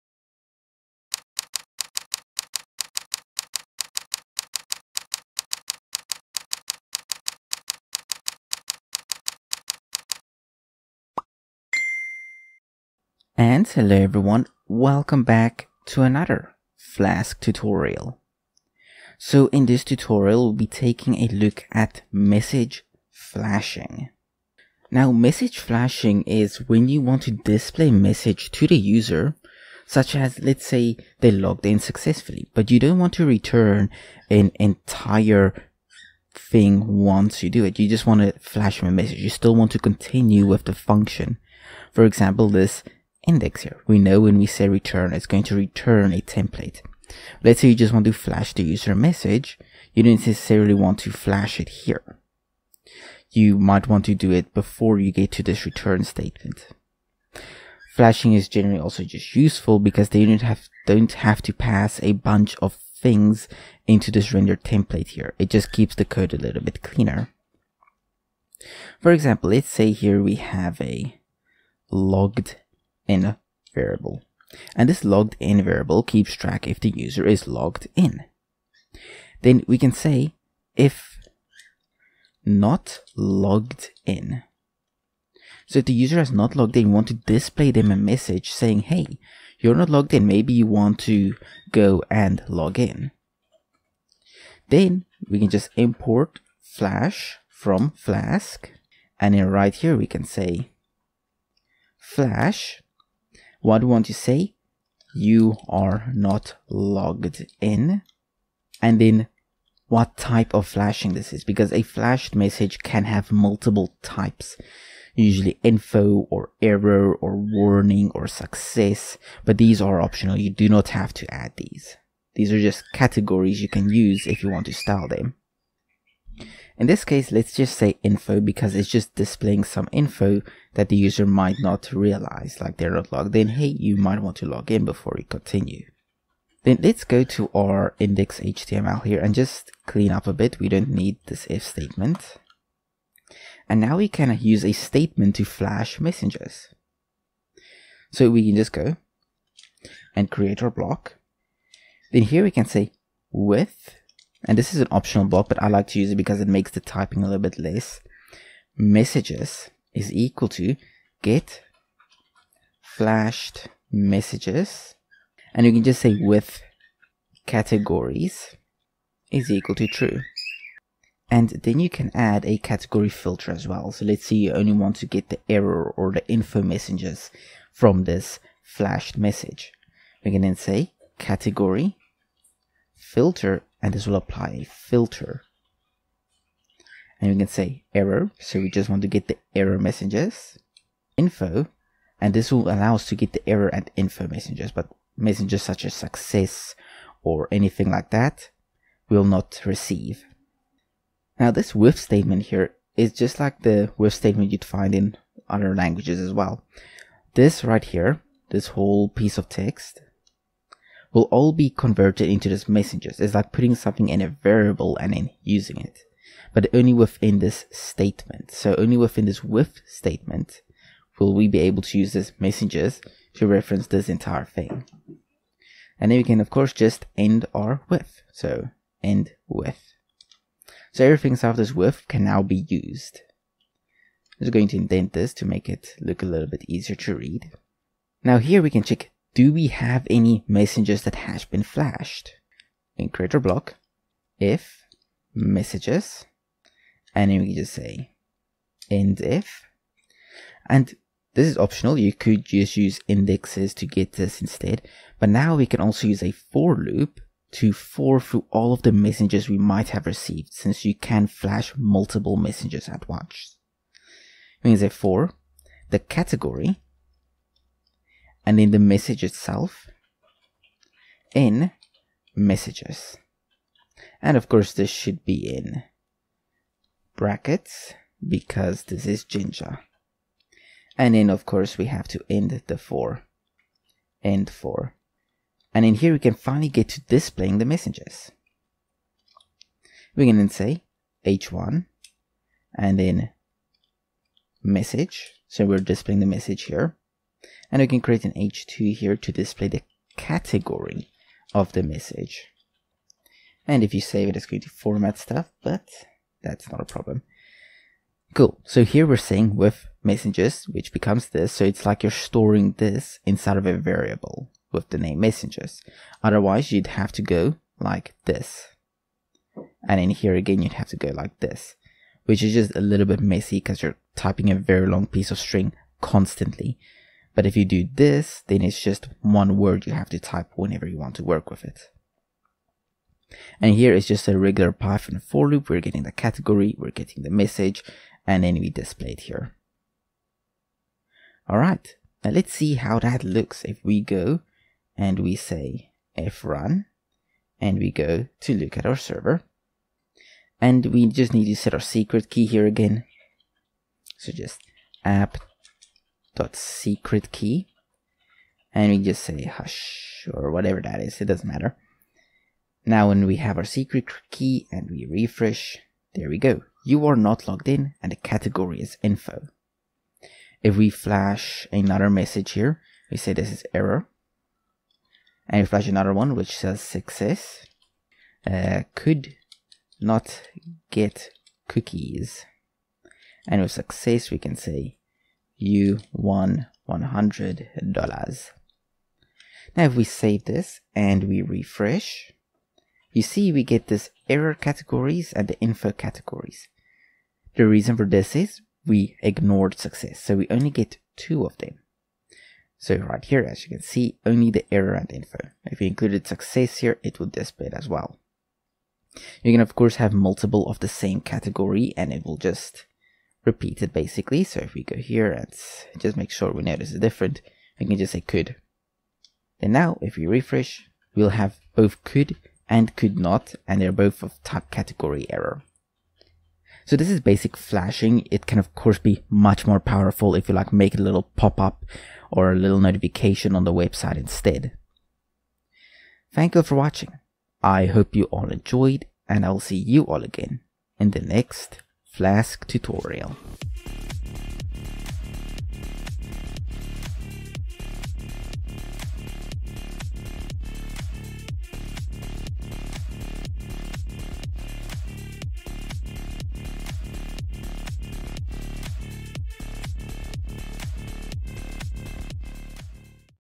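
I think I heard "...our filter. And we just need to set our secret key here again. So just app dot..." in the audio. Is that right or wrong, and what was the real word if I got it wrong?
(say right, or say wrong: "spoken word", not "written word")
wrong: "server", not "filter".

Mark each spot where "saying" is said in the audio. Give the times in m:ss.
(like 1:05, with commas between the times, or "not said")
1:28, 5:09.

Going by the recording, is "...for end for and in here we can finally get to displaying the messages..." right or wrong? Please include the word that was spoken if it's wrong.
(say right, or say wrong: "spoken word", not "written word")
right.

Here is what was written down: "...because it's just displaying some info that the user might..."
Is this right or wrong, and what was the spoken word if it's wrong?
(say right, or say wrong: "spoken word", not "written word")
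right.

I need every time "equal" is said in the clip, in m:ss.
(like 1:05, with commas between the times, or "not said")
2:40, 2:49.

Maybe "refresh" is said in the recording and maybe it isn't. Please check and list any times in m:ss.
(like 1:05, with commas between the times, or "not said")
6:05, 6:31, 7:00.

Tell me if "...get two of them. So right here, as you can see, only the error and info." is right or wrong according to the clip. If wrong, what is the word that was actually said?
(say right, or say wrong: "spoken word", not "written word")
right.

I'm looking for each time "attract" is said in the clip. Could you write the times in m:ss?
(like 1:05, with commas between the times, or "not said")
not said.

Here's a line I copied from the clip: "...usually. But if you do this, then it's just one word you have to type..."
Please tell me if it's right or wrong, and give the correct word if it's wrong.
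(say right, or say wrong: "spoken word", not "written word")
wrong: "constantly", not "usually".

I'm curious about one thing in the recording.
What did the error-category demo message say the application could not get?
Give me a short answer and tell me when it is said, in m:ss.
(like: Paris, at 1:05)
cookies, at 6:18.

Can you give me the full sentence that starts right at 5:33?
And here is just a regular Python for loop.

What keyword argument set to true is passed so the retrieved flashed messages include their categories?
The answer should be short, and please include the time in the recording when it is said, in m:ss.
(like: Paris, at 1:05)
with categories, at 2:46.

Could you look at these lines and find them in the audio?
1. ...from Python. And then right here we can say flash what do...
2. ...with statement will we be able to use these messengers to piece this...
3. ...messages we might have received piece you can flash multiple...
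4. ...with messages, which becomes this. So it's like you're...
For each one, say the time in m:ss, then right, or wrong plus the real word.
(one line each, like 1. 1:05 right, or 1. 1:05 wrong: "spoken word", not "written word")
1. 1:37 wrong: "Flask", not "Python"
2. 3:39 wrong: "reference", not "piece"
3. 4:18 wrong: "since", not "piece"
4. 5:09 right.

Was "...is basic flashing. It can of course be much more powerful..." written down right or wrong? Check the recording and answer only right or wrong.
right.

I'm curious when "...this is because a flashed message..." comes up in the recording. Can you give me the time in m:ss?
1:51.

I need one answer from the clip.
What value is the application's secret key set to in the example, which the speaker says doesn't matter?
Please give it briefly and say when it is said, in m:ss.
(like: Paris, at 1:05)
hush, at 5:59.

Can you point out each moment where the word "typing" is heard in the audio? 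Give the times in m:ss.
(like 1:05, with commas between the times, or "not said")
2:36, 5:24.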